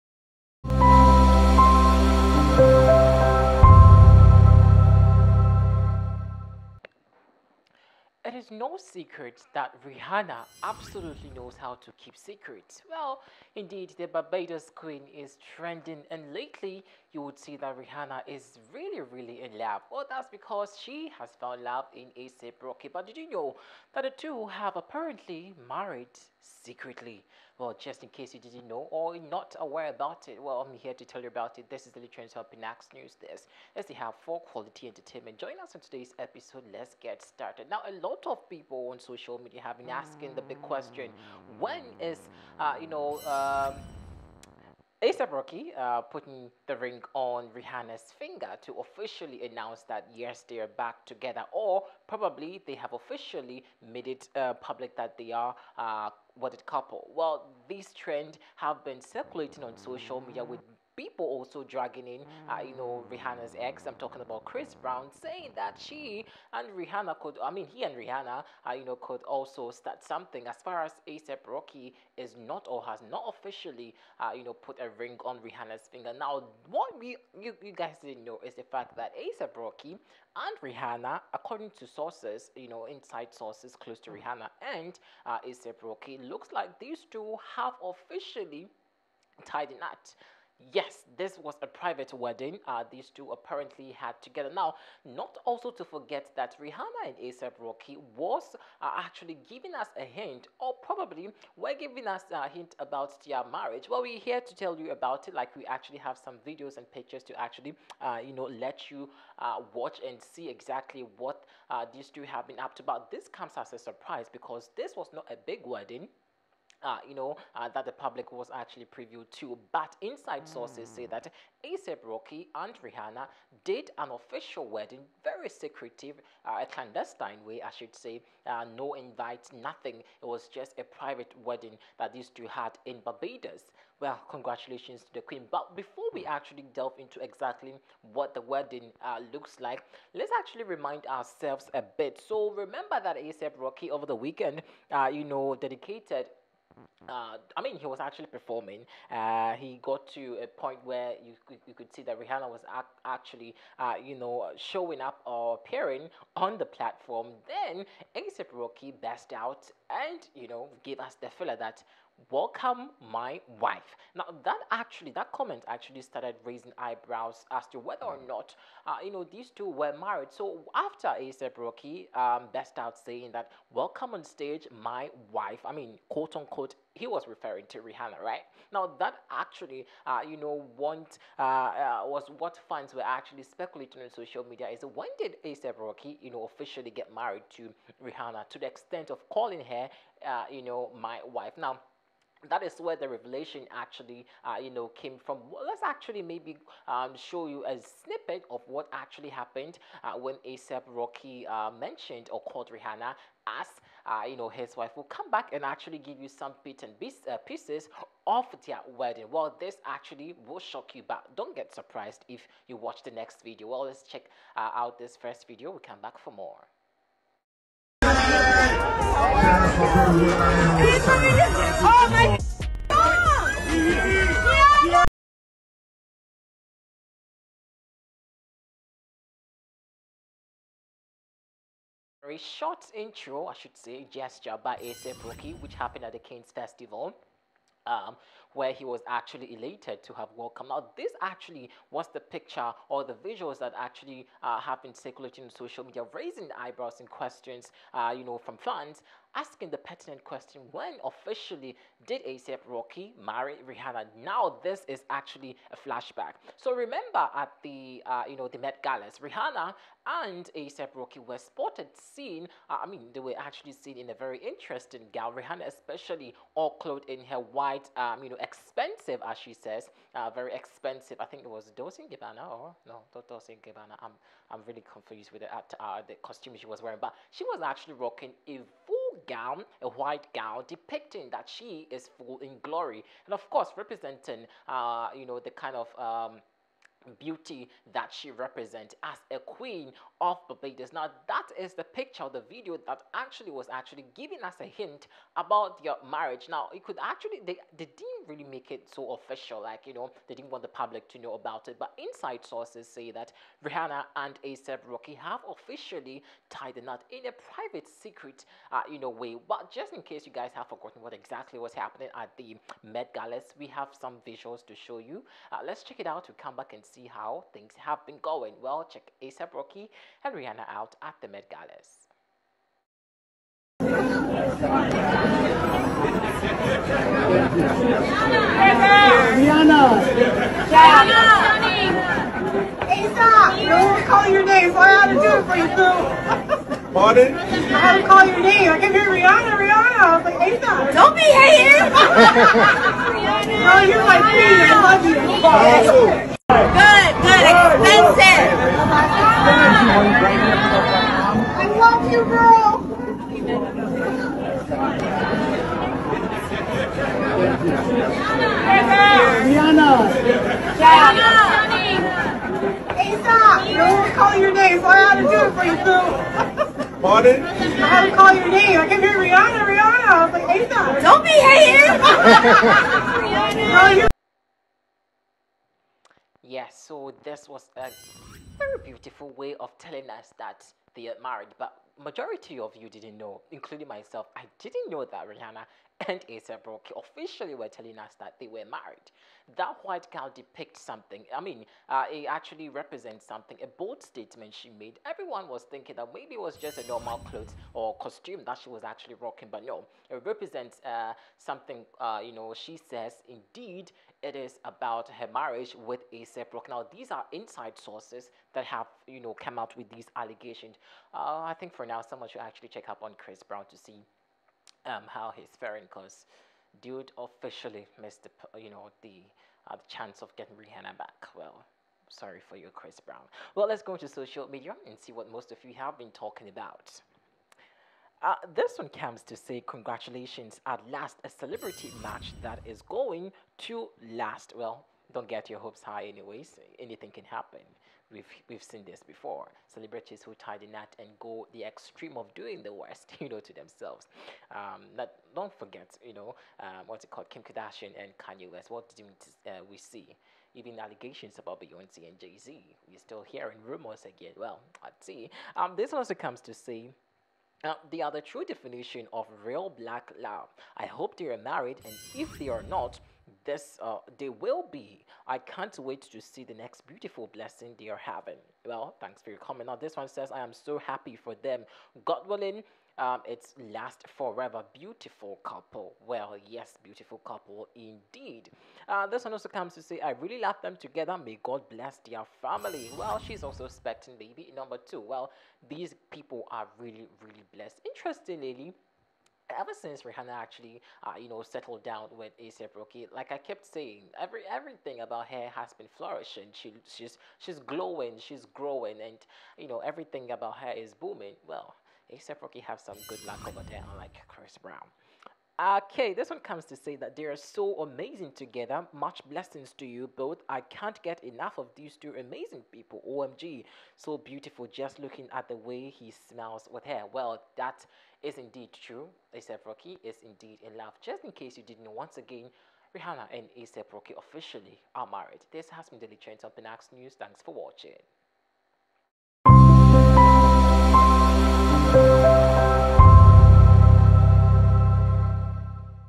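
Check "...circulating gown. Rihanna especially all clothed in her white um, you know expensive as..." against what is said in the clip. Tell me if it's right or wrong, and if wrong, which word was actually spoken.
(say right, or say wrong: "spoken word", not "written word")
wrong: "interesting", not "circulating".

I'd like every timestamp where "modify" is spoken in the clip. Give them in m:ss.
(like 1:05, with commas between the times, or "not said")
not said.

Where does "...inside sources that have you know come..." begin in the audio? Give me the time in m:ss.
6:47.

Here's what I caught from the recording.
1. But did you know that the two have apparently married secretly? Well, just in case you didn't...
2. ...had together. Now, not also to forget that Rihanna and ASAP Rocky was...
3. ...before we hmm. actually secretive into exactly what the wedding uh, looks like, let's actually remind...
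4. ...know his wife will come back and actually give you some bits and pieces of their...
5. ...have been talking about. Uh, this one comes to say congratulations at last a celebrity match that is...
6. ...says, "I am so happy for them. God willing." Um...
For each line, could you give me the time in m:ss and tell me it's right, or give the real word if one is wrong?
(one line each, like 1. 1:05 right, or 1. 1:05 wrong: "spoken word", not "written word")
1. 0:22 right
2. 1:33 right
3. 2:15 wrong: "delve", not "secretive"
4. 3:24 right
5. 7:05 right
6. 7:50 right.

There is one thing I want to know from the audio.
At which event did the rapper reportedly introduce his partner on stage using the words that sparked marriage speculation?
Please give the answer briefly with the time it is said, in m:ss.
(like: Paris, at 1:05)
King's Festival, at 3:56.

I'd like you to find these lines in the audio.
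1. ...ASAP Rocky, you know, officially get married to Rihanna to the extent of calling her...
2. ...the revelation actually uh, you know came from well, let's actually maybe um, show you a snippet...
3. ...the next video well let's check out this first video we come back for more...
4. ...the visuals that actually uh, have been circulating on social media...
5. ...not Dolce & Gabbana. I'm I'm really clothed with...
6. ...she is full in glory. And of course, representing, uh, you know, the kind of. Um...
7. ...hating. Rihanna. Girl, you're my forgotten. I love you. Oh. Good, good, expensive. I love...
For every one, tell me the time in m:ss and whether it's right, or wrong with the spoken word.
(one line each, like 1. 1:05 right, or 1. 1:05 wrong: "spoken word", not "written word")
1. 3:05 right
2. 3:12 right
3. 3:33 right
4. 4:03 right
5. 4:33 wrong: "confused", not "clothed"
6. 4:41 right
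7. 5:41 wrong: "queen", not "forgotten".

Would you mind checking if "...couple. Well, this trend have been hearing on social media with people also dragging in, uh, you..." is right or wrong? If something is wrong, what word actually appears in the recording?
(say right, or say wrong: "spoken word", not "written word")
wrong: "circulating", not "hearing".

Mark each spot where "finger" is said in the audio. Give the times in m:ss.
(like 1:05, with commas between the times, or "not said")
0:48, 1:15.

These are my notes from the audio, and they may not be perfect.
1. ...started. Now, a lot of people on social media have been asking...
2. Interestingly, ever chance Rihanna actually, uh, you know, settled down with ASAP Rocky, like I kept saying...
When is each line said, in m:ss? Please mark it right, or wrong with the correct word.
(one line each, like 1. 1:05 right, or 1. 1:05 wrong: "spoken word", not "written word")
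1. 0:37 right
2. 8:07 wrong: "since", not "chance".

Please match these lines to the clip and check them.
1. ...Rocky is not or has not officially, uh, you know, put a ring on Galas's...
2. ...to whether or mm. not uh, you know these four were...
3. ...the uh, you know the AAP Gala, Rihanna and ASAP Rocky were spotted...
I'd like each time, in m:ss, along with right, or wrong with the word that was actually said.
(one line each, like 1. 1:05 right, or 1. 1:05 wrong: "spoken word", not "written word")
1. 1:11 wrong: "Rihanna", not "Galas"
2. 2:47 wrong: "two", not "four"
3. 4:17 wrong: "Met", not "AAP".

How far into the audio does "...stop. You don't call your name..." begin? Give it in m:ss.
6:03.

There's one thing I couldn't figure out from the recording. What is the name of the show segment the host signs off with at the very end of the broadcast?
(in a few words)
Daily Trends.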